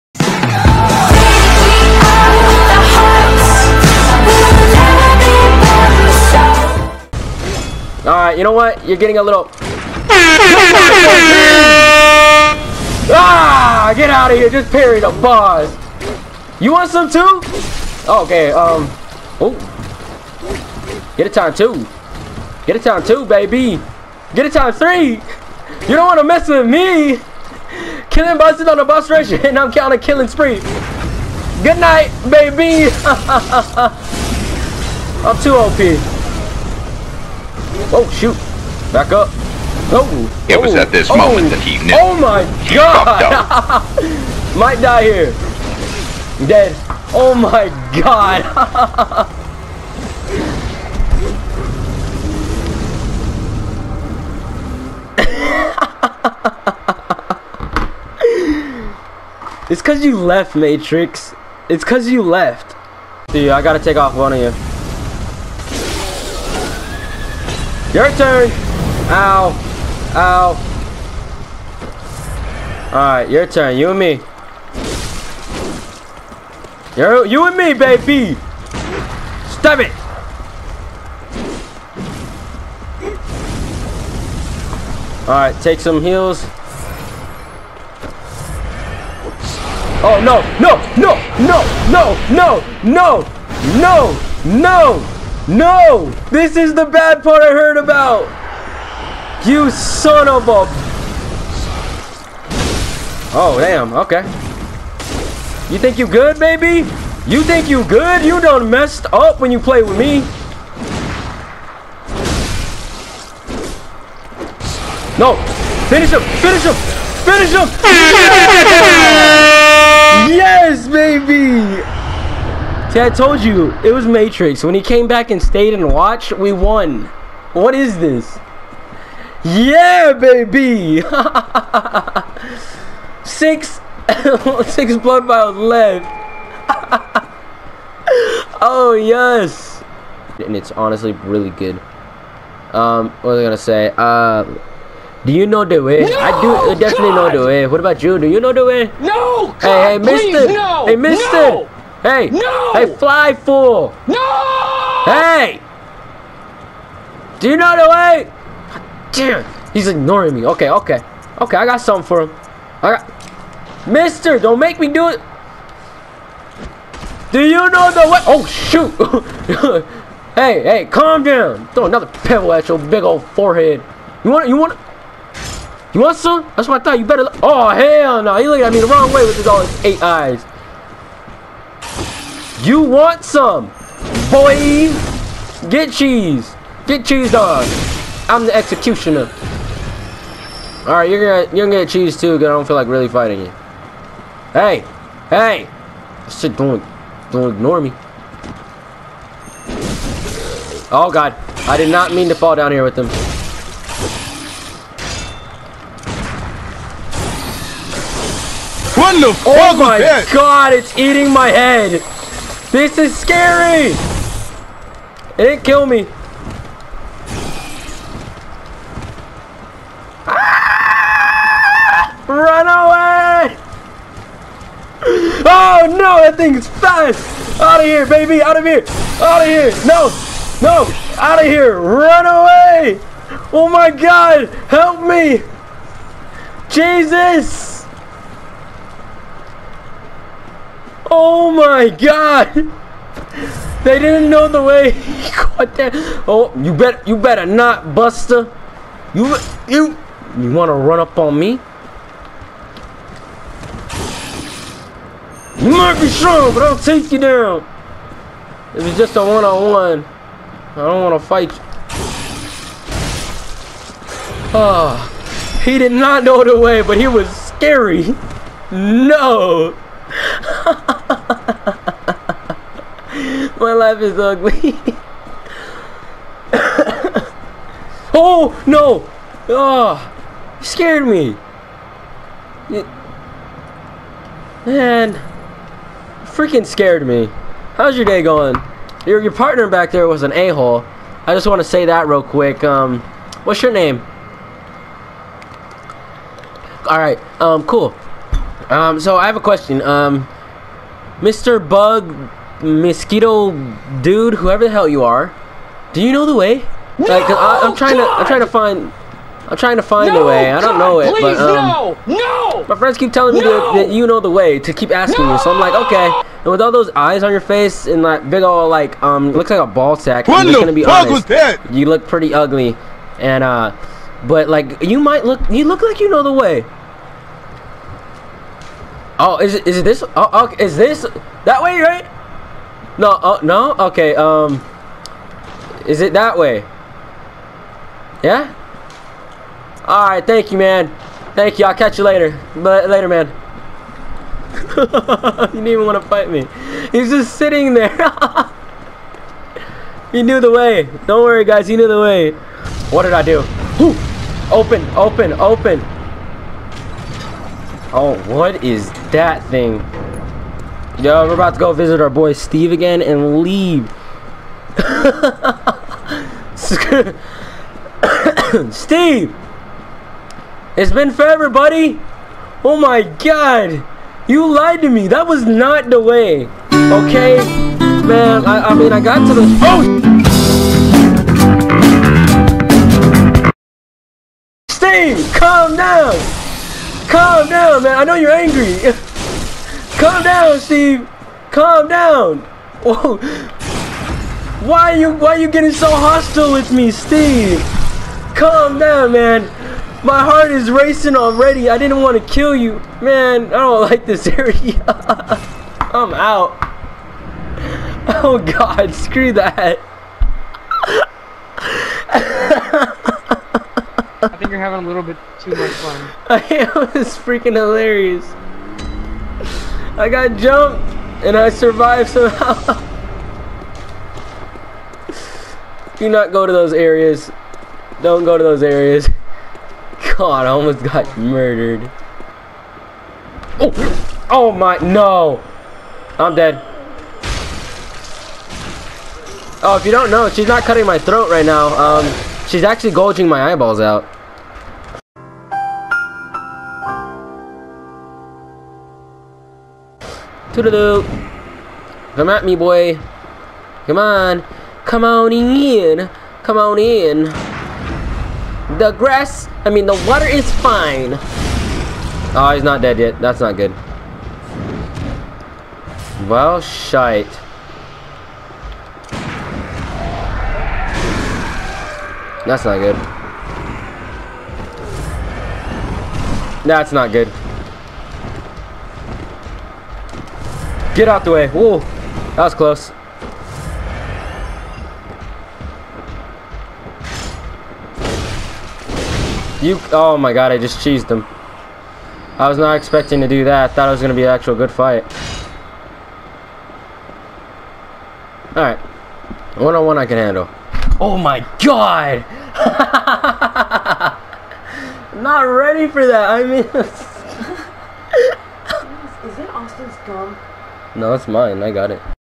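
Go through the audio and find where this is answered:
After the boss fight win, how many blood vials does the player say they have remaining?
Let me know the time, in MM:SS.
02:14.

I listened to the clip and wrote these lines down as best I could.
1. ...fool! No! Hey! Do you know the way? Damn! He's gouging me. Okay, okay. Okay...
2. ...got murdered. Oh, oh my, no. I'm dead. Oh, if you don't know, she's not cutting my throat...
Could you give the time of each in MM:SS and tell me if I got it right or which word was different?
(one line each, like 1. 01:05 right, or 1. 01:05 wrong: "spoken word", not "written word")
1. 02:33 wrong: "ignoring", not "gouging"
2. 07:10 right.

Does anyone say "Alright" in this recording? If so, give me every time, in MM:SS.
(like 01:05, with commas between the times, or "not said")
01:12, 01:25, 05:39, 08:18.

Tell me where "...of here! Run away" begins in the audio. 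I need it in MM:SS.
03:51.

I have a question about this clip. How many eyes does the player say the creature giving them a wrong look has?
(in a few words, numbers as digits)
8.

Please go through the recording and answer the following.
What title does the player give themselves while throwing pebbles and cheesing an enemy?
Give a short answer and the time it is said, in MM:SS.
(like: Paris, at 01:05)
the executioner, at 03:08.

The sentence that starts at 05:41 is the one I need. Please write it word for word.
Thank you, I'll catch you later.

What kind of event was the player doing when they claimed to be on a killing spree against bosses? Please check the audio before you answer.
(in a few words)
boss rush.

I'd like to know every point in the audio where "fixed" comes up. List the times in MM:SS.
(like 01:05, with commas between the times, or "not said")
not said.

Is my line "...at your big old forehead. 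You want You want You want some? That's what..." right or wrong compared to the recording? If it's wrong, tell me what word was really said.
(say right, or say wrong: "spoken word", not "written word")
right.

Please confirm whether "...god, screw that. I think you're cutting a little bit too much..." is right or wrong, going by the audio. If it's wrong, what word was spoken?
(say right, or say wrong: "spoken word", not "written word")
wrong: "having", not "cutting".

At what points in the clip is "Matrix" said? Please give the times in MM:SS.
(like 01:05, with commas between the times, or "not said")
01:00, 02:04.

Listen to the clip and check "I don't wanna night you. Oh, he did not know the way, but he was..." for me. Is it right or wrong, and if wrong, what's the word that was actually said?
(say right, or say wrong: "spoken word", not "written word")
wrong: "fight", not "night".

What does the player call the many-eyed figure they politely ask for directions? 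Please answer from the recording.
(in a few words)
Mr. Bug mosquito dude.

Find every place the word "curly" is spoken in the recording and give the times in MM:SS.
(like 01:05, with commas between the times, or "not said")
not said.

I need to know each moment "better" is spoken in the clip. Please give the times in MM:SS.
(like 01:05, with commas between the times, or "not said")
02:57, 04:07.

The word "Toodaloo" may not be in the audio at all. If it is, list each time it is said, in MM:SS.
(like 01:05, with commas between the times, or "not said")
07:30.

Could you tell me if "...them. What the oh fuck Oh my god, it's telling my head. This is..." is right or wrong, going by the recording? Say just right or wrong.
wrong.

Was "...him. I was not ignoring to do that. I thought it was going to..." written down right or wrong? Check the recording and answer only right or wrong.
wrong.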